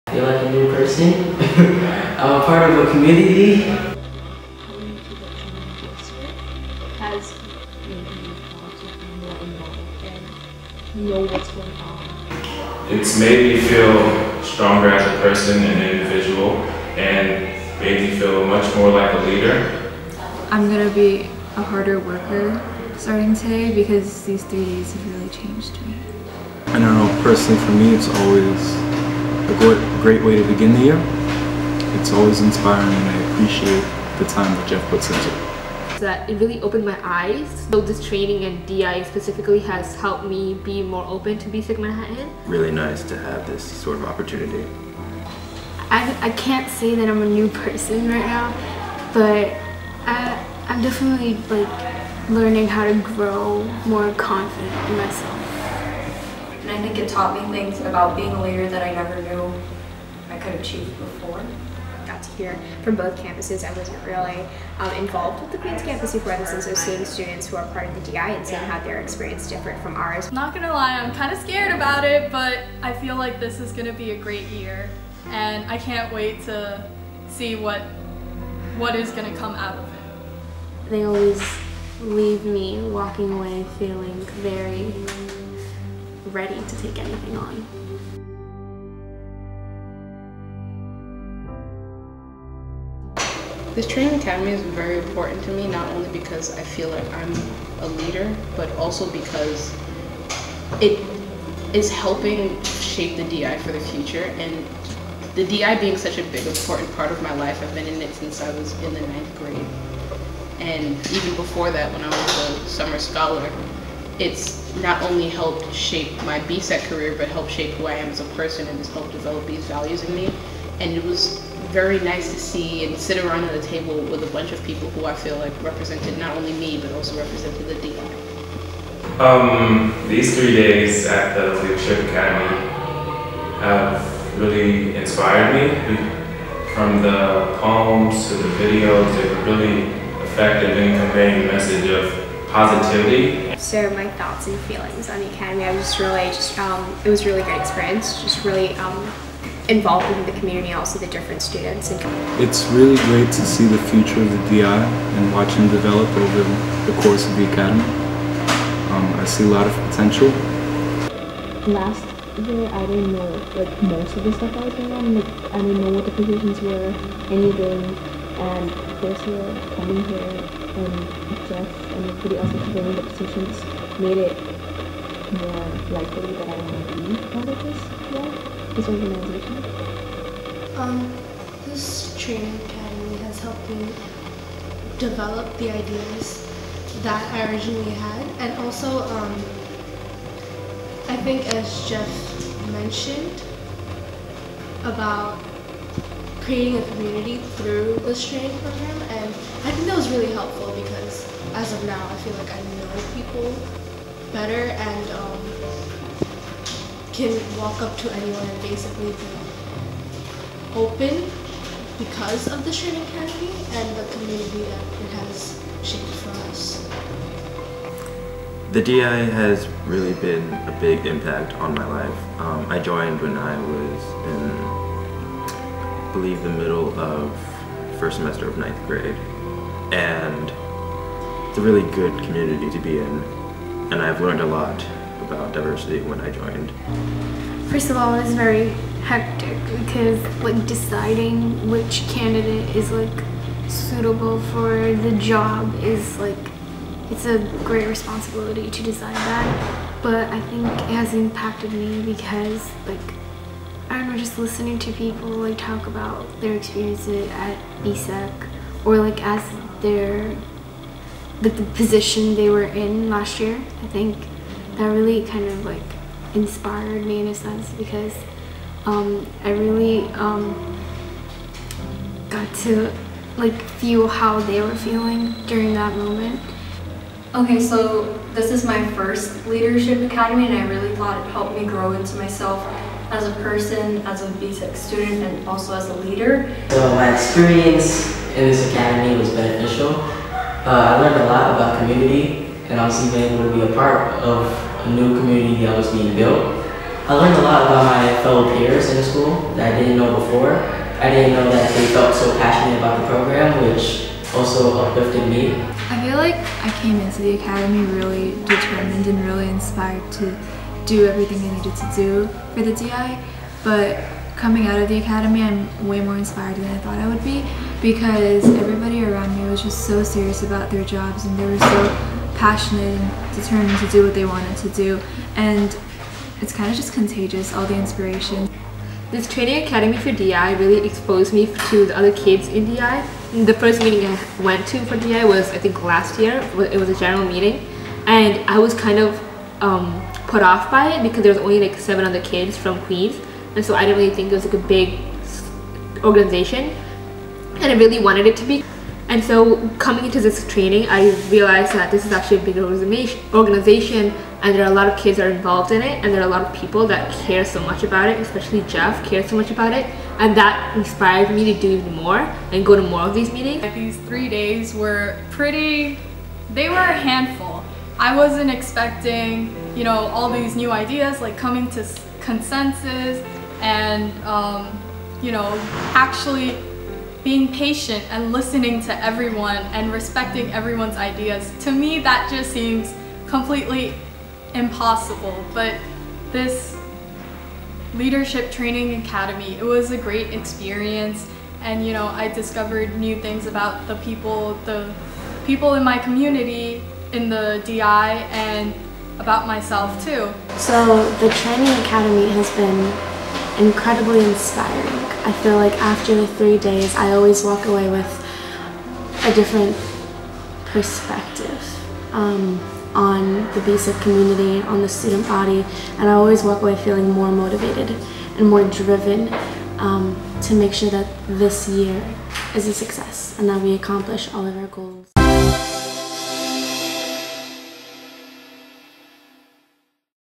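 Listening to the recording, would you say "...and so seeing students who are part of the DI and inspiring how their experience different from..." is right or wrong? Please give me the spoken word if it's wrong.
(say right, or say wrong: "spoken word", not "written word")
wrong: "seeing", not "inspiring".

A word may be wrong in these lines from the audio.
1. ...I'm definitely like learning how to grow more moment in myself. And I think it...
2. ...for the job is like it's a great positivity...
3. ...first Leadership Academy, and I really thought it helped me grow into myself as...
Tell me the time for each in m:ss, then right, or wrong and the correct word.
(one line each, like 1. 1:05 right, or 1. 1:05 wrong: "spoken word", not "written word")
1. 0:50 wrong: "confident", not "moment"
2. 4:04 wrong: "responsibility", not "positivity"
3. 4:38 right.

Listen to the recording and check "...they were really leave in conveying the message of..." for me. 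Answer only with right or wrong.
wrong.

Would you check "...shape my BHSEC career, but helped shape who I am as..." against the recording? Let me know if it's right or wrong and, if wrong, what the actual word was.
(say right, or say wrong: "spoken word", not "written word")
right.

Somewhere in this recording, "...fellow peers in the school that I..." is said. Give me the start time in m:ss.
4:58.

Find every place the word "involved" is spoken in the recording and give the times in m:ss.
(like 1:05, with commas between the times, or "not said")
1:04, 2:29, 5:55.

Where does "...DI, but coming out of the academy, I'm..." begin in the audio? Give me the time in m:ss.
5:12.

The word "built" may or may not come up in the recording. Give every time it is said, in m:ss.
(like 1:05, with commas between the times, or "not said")
4:56.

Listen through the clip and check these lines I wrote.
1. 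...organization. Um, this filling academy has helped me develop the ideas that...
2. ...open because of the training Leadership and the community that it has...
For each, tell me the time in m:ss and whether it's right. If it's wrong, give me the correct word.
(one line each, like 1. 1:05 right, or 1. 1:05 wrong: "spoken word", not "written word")
1. 2:58 wrong: "training", not "filling"
2. 3:30 wrong: "Academy", not "Leadership".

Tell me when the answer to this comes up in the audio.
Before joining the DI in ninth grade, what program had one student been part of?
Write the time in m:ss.
1:52.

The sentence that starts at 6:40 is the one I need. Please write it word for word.
So the training academy has been incredibly inspiring.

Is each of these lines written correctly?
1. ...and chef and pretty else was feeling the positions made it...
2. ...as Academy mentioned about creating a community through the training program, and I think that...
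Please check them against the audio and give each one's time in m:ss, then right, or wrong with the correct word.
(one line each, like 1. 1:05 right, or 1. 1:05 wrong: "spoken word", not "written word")
1. 2:50 wrong: "filling", not "feeling"
2. 3:11 wrong: "Jeff", not "Academy".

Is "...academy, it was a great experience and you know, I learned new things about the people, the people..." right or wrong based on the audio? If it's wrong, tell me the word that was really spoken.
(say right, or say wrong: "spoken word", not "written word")
wrong: "discovered", not "learned".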